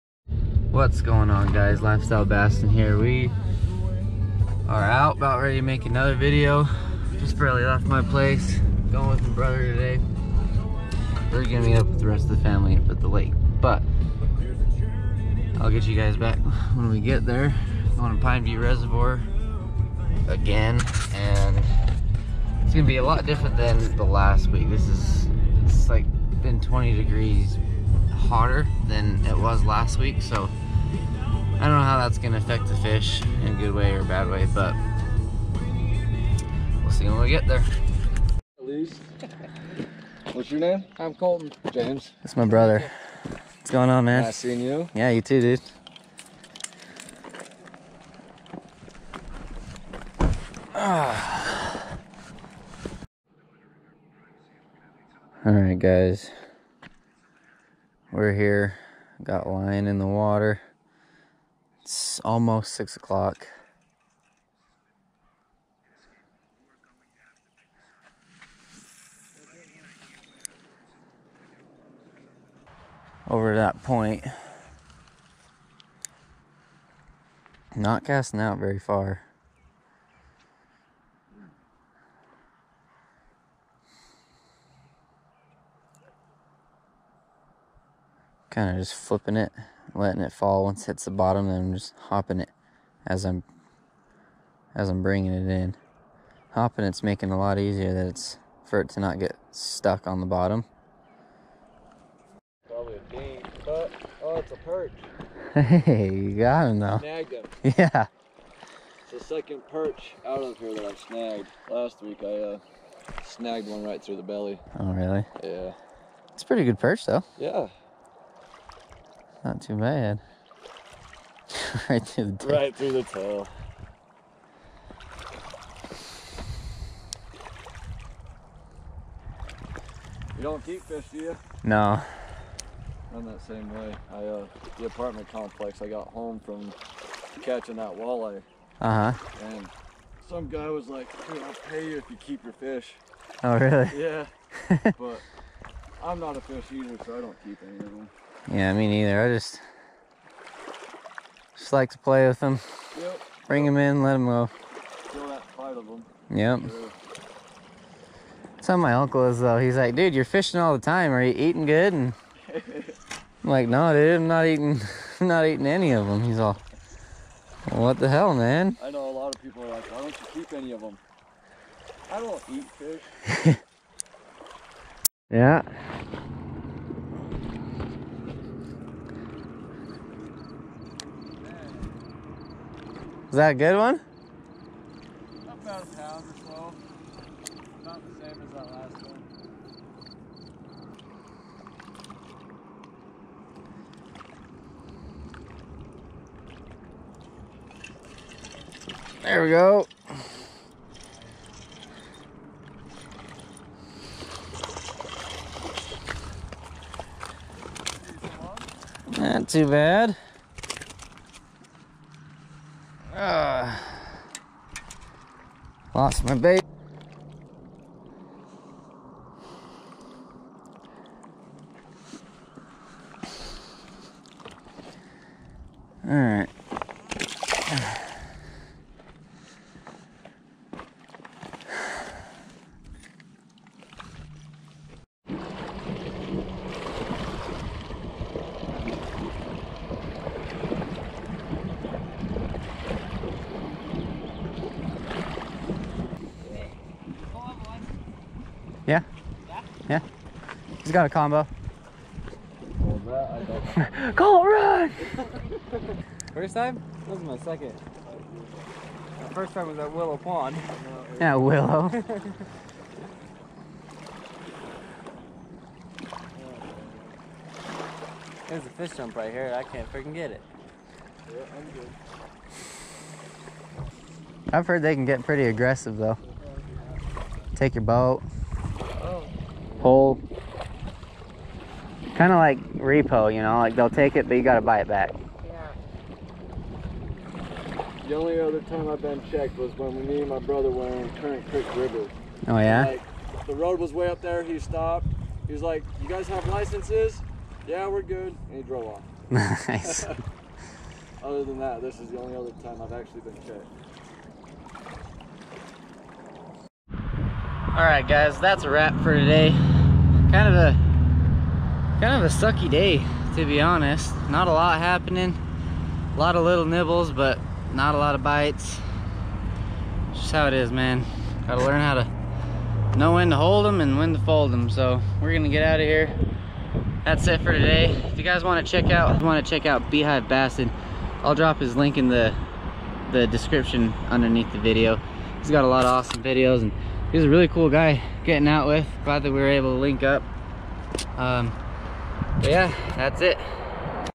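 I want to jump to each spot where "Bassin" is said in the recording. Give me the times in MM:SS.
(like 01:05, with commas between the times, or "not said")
00:02, 05:30.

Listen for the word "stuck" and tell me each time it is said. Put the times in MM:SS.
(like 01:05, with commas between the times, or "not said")
01:39.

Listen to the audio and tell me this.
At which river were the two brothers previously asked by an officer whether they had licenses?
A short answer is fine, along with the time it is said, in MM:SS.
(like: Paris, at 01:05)
Currant Creek River, at 04:51.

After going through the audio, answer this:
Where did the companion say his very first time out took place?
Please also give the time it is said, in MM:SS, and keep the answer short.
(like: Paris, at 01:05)
Willow Pond, at 04:19.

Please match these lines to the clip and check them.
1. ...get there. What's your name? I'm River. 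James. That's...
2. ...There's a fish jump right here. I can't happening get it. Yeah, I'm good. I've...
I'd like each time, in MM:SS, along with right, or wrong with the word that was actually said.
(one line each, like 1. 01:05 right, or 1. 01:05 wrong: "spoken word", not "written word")
1. 00:37 wrong: "Colton", not "River"
2. 04:28 wrong: "freaking", not "happening".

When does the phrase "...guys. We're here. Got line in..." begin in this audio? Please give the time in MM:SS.
00:55.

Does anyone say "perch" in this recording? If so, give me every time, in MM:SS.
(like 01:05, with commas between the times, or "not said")
01:44, 01:49, 01:56.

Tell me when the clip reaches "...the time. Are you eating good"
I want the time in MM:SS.
02:40.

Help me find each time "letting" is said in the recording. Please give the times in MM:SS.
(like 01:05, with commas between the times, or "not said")
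01:29.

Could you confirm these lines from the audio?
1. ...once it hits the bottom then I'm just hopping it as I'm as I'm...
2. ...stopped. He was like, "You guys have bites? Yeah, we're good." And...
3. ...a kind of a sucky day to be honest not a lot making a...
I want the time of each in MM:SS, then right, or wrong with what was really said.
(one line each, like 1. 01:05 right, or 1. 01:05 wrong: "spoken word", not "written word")
1. 01:30 right
2. 04:54 wrong: "licenses", not "bites"
3. 05:10 wrong: "happening", not "making".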